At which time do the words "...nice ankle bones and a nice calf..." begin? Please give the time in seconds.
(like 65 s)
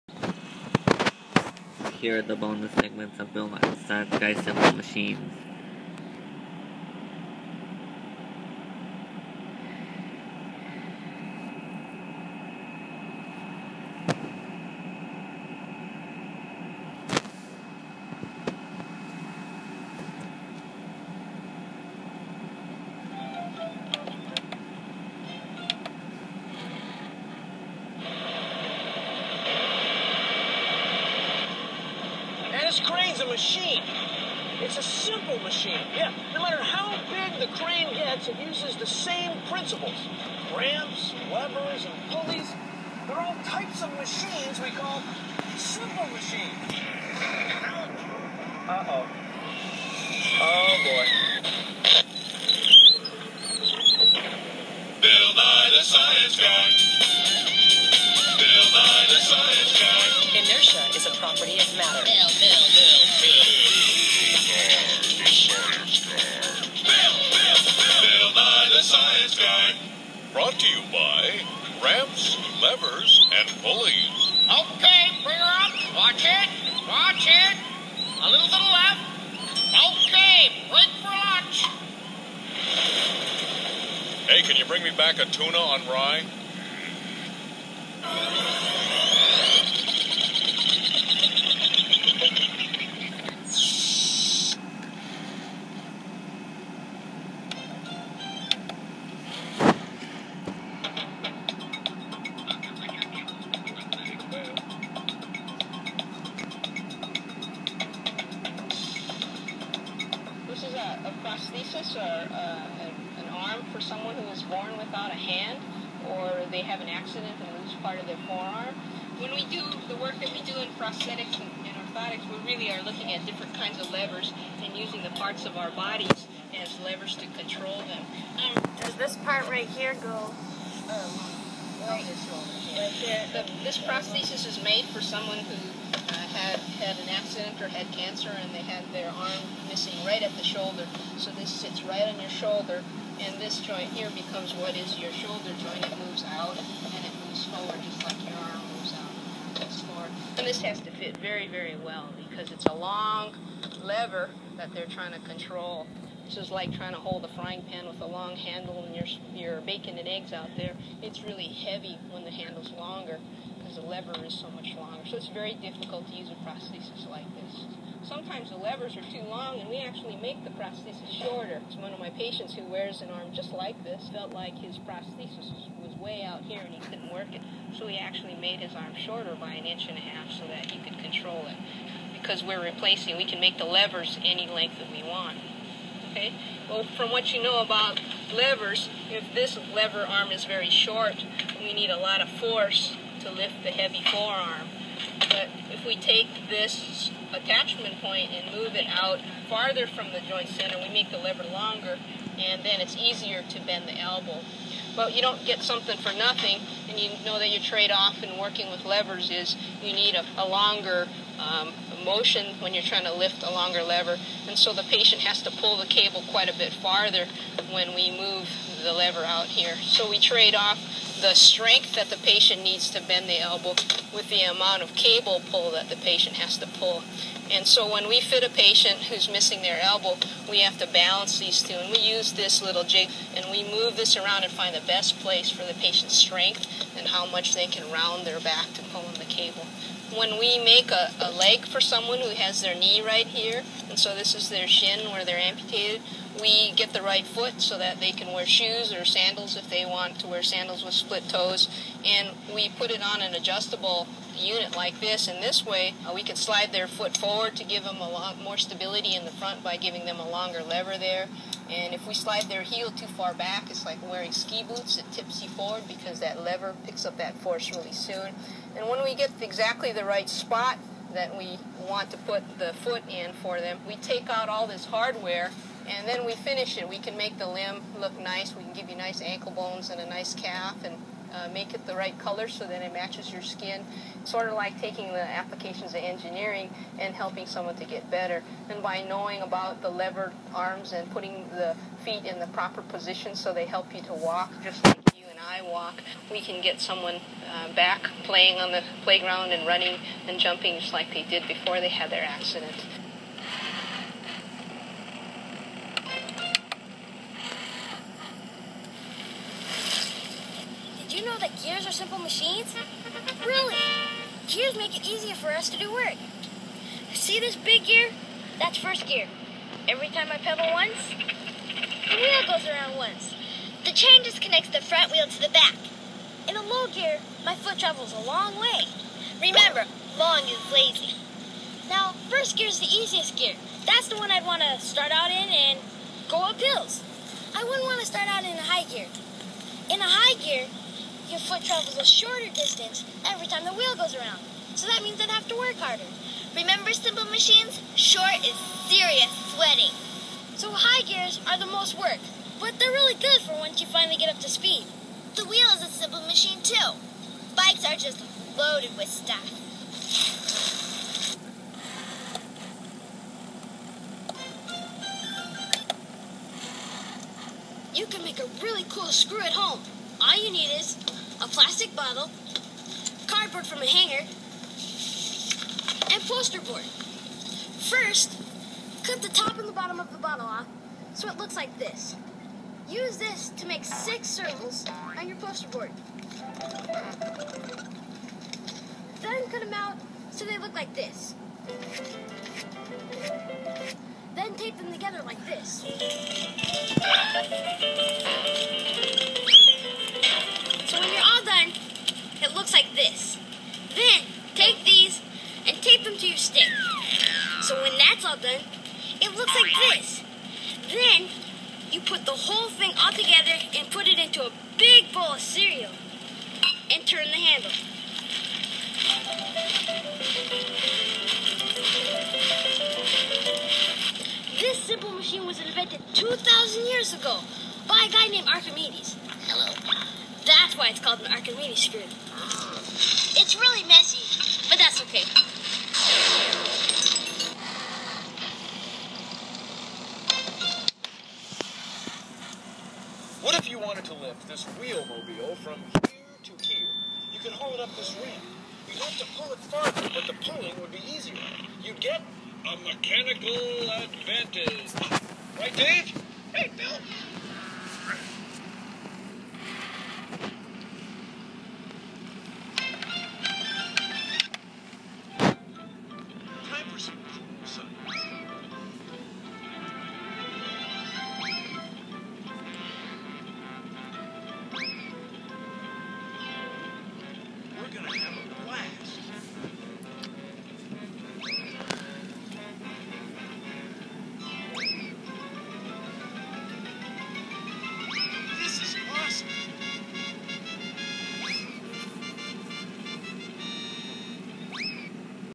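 278 s.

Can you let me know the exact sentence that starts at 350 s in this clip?
So high gears are the most work, but they're really good for once you finally get up to speed.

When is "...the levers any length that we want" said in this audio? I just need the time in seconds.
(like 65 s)
183 s.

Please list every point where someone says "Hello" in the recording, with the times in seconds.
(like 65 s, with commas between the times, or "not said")
429 s.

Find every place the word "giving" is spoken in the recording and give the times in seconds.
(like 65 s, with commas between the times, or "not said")
259 s.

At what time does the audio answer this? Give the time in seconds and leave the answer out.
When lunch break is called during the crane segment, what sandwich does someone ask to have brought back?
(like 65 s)
85 s.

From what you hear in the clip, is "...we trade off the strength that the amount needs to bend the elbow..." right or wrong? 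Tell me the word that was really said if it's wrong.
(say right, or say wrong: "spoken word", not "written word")
wrong: "patient", not "amount".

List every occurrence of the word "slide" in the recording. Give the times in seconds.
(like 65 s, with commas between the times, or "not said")
256 s, 262 s.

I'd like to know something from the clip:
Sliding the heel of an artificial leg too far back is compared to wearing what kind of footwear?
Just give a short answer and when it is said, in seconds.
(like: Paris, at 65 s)
ski boots, at 264 s.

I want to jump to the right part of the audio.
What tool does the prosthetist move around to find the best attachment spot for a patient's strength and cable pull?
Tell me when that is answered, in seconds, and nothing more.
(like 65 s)
232 s.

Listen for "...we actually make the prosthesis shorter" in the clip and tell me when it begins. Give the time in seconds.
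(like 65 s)
169 s.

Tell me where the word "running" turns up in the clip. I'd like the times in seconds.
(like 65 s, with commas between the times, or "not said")
299 s.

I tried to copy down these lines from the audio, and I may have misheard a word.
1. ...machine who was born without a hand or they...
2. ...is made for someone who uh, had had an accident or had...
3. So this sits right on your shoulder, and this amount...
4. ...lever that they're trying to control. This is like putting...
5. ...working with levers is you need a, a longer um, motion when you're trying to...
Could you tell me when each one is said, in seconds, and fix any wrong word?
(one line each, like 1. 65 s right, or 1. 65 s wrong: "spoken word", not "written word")
1. 113 s wrong: "someone", not "machine"
2. 134 s right
3. 141 s wrong: "joint", not "amount"
4. 153 s wrong: "trying", not "putting"
5. 208 s right.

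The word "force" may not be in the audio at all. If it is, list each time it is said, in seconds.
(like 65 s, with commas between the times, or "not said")
192 s, 267 s.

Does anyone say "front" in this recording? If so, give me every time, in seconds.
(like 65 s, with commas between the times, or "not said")
259 s, 324 s.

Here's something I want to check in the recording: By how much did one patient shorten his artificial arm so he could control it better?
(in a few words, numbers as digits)
an inch and a half.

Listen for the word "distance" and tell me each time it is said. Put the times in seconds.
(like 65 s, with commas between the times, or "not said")
342 s.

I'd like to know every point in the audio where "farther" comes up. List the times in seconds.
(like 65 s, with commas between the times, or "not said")
199 s, 216 s, 449 s.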